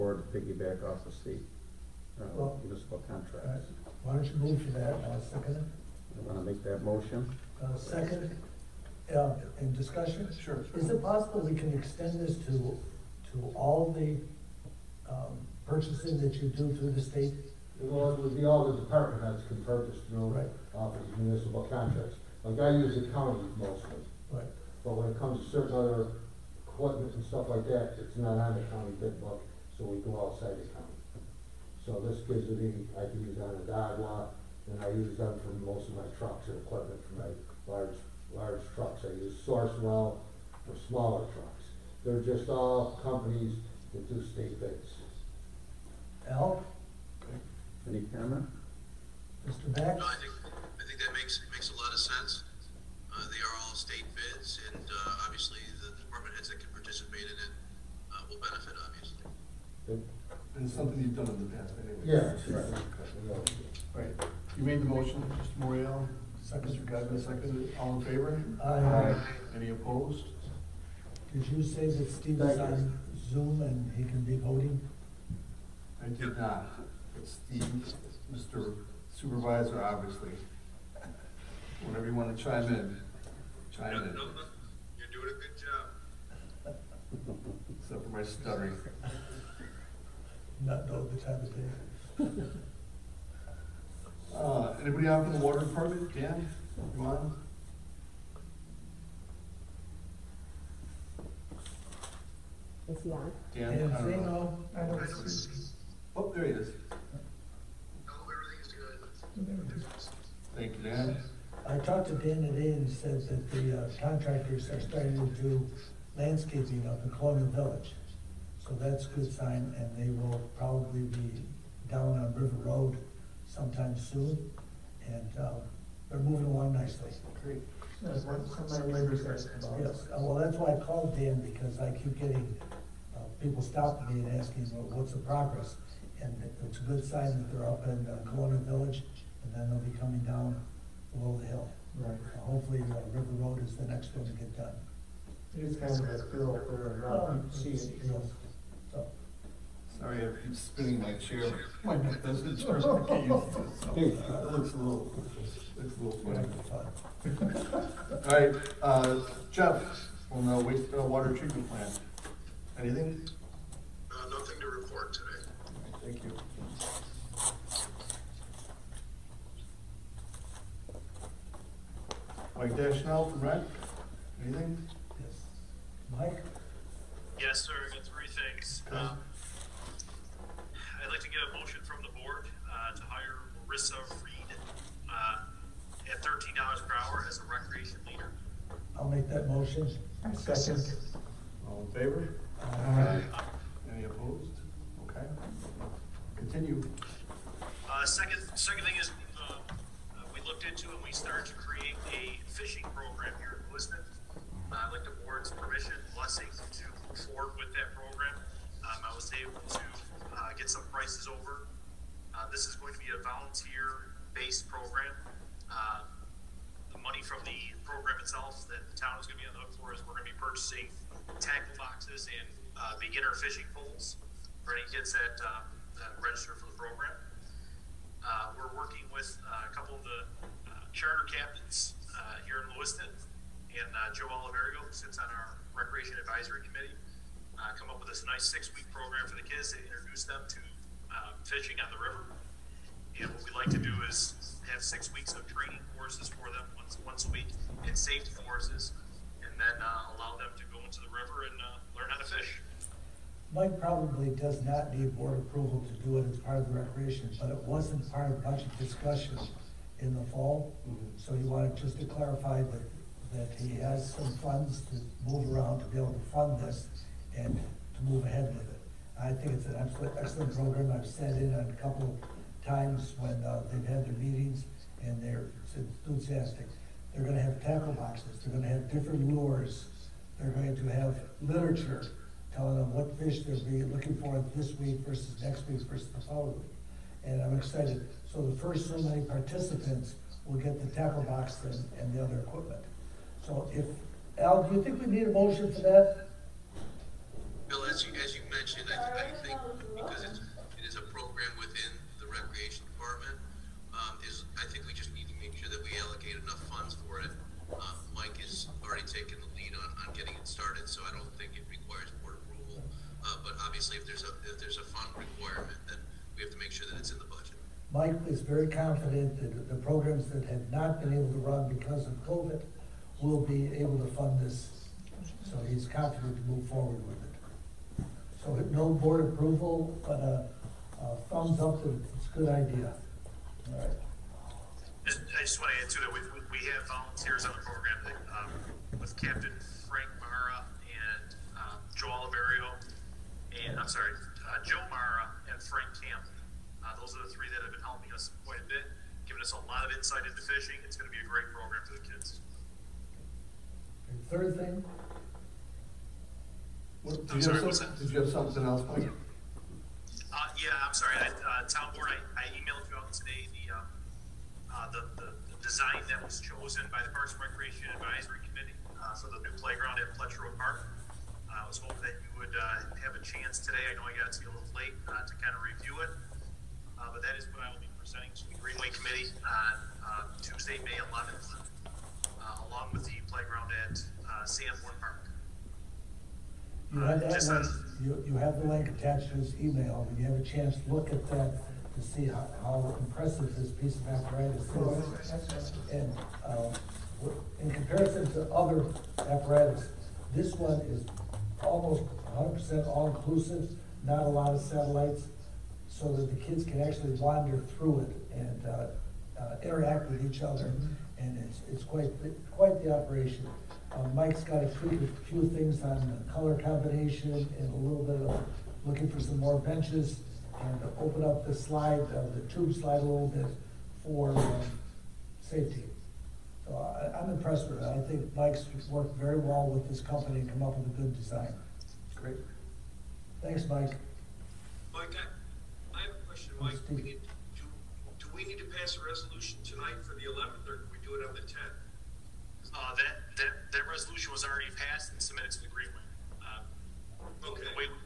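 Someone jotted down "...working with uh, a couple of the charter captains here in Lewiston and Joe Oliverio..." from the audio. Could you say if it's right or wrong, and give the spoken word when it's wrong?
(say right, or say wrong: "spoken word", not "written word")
right.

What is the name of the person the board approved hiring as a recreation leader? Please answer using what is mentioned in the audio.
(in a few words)
Marissa Reed.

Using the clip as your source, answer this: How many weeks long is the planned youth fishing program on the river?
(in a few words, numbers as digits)
6 weeks.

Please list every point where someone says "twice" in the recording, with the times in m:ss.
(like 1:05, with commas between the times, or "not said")
not said.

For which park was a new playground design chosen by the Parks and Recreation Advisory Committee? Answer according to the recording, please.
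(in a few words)
Fletcher Road Park.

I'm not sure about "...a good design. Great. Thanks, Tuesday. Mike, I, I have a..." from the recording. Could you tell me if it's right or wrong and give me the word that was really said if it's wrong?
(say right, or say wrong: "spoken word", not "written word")
wrong: "Mike", not "Tuesday".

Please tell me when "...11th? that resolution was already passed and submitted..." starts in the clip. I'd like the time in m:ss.
7:20.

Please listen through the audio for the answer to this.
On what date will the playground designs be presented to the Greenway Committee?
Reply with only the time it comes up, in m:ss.
6:20.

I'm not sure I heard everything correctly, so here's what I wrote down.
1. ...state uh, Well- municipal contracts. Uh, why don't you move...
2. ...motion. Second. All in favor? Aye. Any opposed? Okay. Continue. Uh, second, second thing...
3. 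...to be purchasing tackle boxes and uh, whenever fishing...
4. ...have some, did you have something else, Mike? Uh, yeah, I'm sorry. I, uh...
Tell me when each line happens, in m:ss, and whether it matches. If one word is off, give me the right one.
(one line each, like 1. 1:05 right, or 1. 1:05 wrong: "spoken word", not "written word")
1. 0:01 right
2. 3:09 right
3. 3:40 wrong: "beginner", not "whenever"
4. 5:57 right.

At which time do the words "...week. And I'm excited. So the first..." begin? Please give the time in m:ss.
4:46.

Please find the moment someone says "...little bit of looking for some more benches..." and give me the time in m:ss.
6:57.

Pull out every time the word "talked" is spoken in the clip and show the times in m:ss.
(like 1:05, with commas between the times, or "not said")
1:51.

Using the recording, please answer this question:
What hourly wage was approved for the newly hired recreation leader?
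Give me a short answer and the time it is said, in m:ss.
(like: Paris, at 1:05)
$13 per hour, at 3:06.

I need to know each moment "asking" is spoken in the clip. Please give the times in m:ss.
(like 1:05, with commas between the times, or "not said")
2:14.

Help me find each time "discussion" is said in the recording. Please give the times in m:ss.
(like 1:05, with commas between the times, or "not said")
0:09, 4:18.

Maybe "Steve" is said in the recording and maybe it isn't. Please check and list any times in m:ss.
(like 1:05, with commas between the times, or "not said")
1:12, 1:17.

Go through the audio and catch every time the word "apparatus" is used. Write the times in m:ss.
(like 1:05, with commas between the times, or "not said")
6:34, 6:39.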